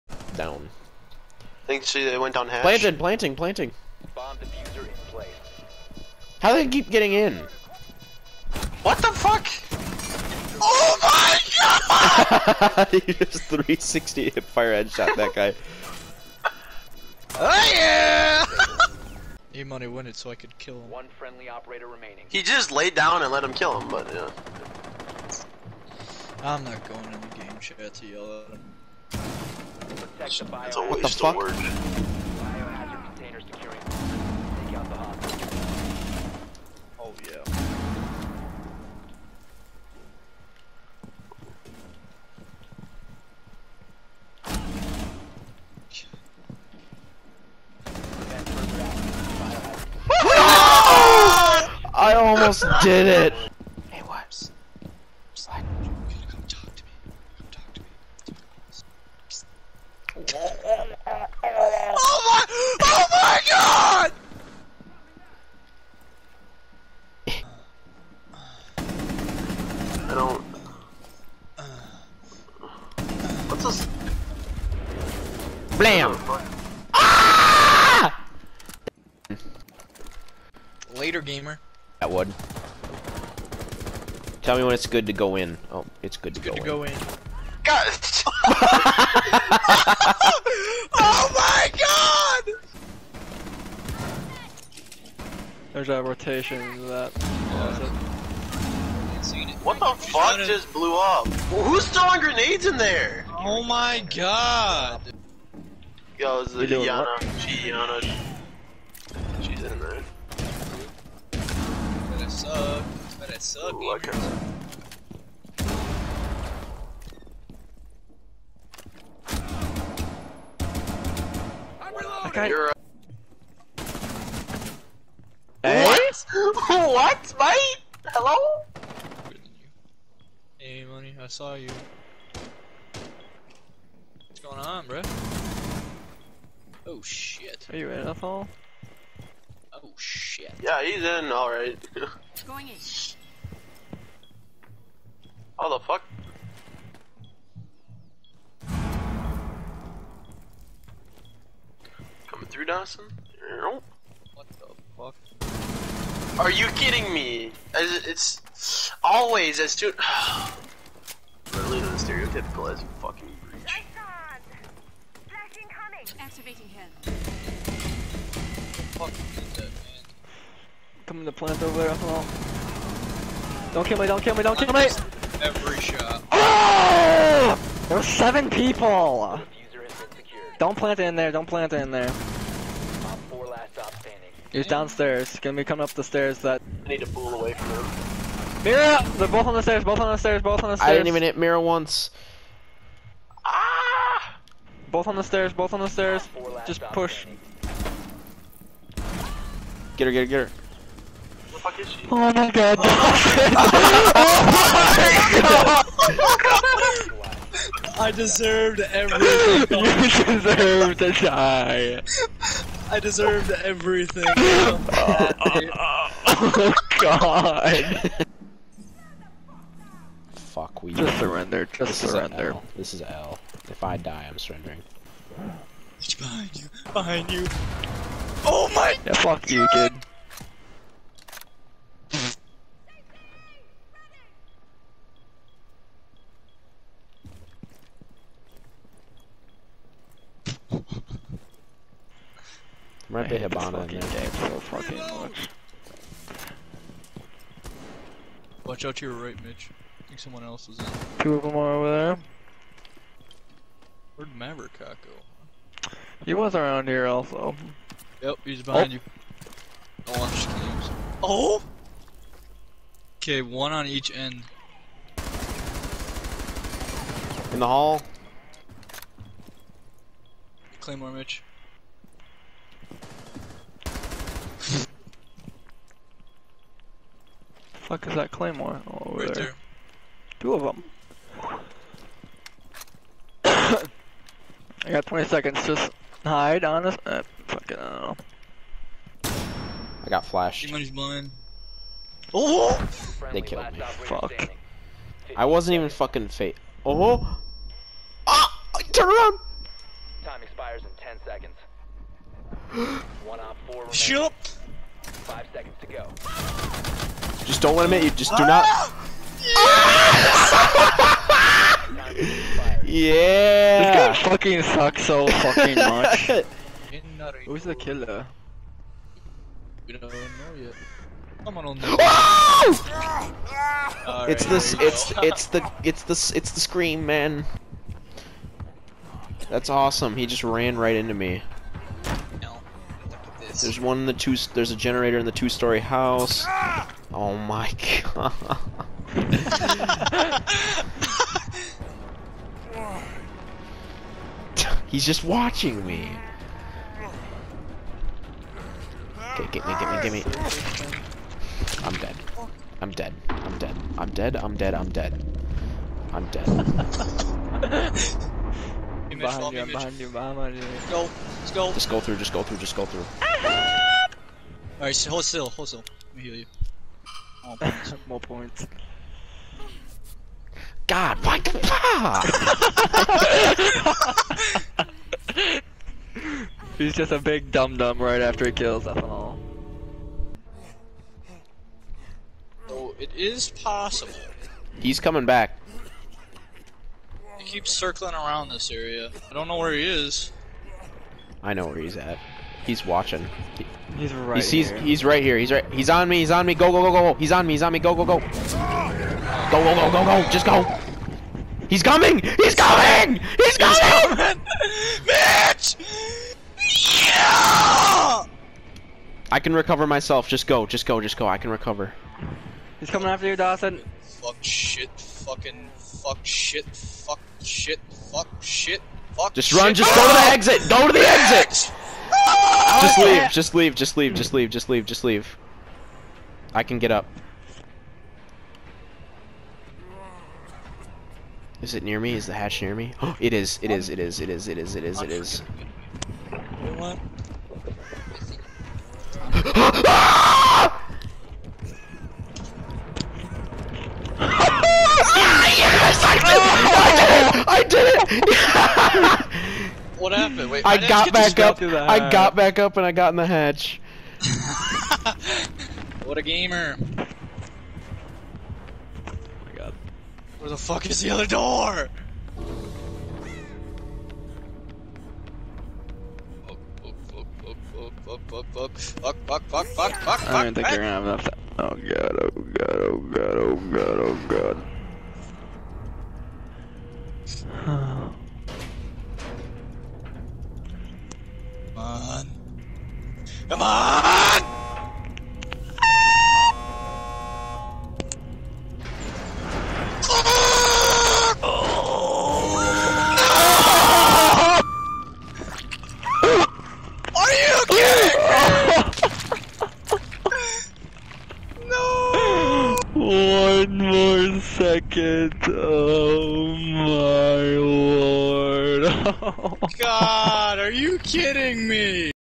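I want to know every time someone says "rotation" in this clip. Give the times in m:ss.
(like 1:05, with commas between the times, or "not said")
1:36.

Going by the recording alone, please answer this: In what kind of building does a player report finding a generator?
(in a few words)
two-story house.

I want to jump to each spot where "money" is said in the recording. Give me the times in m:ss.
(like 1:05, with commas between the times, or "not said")
0:19, 2:10.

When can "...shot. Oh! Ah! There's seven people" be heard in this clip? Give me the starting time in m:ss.
2:55.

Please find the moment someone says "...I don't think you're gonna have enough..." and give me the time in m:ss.
7:50.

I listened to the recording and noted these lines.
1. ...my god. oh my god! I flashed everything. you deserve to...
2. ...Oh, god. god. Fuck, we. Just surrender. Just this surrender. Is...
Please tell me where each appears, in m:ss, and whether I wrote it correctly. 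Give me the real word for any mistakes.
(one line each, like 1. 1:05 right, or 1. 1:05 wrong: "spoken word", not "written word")
1. 3:22 wrong: "deserved", not "flashed"
2. 3:36 right.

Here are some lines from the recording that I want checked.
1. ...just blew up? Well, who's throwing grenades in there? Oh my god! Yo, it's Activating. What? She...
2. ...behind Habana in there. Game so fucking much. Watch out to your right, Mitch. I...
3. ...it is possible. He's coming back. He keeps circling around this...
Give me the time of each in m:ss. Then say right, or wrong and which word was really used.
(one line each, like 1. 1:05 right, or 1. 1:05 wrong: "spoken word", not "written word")
1. 1:40 wrong: "Yana", not "Activating"
2. 4:03 right
3. 6:22 right.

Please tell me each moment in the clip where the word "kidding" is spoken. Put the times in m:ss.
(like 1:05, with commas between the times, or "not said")
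2:36, 8:30.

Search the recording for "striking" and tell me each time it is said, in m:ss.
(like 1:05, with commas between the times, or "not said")
not said.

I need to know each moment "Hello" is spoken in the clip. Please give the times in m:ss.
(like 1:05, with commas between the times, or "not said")
2:08.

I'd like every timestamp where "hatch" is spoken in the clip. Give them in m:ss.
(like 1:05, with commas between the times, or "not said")
7:12, 7:33.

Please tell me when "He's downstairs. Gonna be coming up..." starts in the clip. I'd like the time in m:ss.
3:04.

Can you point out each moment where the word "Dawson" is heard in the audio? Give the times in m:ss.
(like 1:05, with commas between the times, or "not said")
2:32, 6:53.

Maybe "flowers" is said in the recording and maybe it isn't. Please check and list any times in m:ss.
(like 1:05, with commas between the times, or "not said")
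not said.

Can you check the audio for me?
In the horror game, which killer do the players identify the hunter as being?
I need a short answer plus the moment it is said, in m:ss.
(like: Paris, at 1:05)
the scream man, at 5:26.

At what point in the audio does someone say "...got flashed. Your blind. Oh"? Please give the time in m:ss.
4:50.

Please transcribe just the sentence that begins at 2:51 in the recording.
Coming to plant over there, all.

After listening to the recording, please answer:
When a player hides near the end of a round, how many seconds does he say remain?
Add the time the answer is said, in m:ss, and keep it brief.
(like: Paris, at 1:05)
20, at 4:44.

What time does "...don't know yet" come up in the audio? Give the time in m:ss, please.
5:19.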